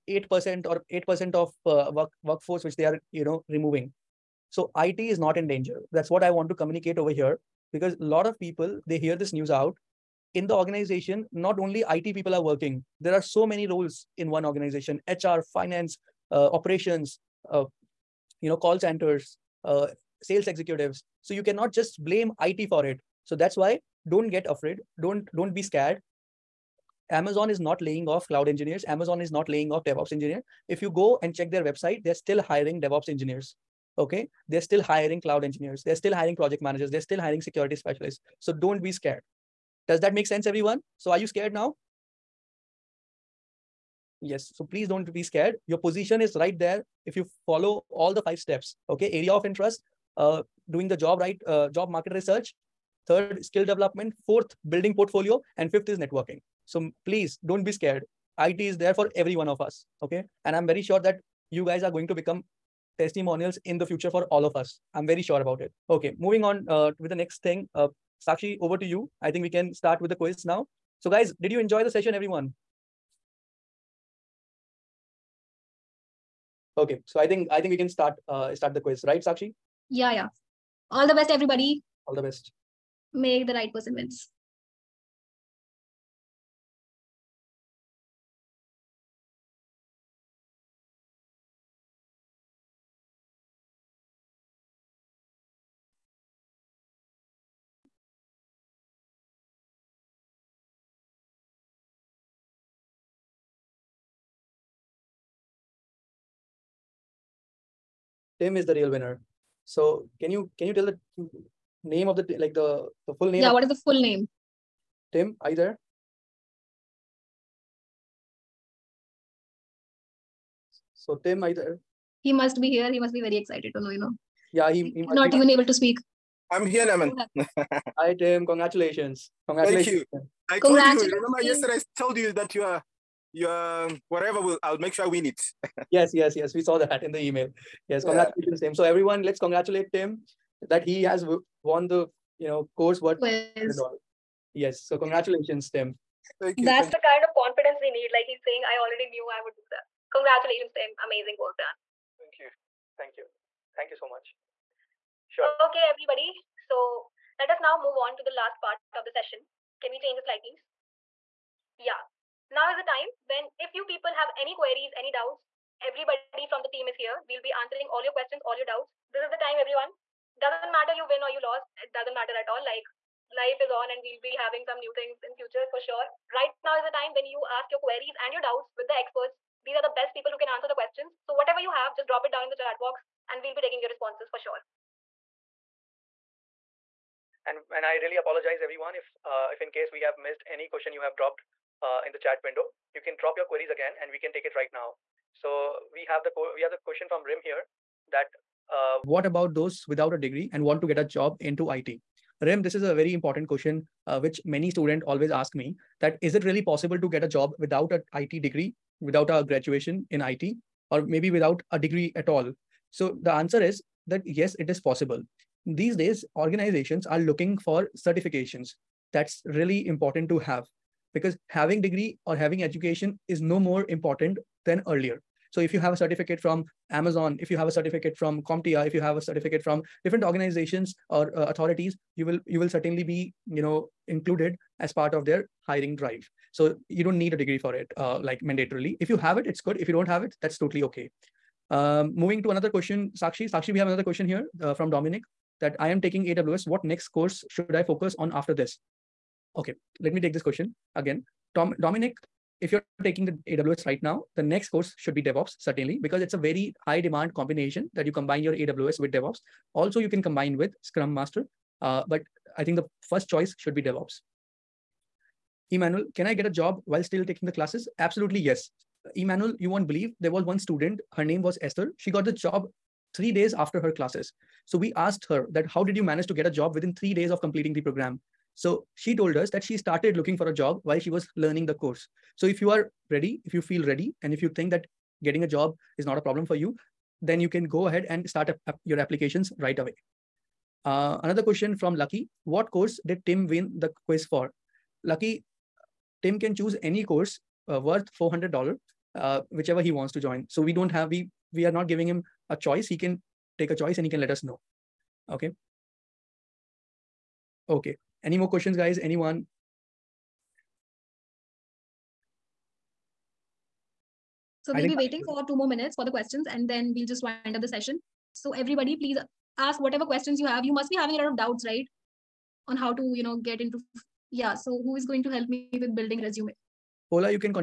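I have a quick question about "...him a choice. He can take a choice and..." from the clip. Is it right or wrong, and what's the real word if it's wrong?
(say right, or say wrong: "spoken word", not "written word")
right.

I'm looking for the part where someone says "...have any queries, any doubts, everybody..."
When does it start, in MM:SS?
02:44.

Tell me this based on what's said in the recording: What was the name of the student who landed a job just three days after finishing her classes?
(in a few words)
Esther.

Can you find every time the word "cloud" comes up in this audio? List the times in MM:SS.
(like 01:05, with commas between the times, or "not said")
00:28, 00:35.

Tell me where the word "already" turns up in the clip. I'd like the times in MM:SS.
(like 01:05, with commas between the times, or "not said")
02:28.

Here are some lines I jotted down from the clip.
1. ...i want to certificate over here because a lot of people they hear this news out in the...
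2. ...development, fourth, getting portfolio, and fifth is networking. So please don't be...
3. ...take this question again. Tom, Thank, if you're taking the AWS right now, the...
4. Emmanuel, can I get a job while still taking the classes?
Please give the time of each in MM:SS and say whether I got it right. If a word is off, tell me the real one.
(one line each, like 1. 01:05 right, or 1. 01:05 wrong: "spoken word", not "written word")
1. 00:06 wrong: "communicate", not "certificate"
2. 00:53 wrong: "building", not "getting"
3. 04:10 wrong: "Dominic", not "Thank"
4. 04:25 right.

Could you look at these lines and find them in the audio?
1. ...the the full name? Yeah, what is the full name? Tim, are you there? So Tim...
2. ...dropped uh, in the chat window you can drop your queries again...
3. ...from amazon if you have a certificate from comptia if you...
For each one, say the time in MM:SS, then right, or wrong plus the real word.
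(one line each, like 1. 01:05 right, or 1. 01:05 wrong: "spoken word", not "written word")
1. 01:52 right
2. 03:11 right
3. 03:46 right.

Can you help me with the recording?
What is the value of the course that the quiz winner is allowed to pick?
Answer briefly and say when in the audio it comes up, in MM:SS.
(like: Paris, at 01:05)
$400, at 04:58.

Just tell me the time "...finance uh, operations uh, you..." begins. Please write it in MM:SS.
00:15.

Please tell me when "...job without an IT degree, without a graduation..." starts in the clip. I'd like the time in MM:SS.
03:27.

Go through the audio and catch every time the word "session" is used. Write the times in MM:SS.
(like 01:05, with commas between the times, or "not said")
01:11, 02:39, 05:17.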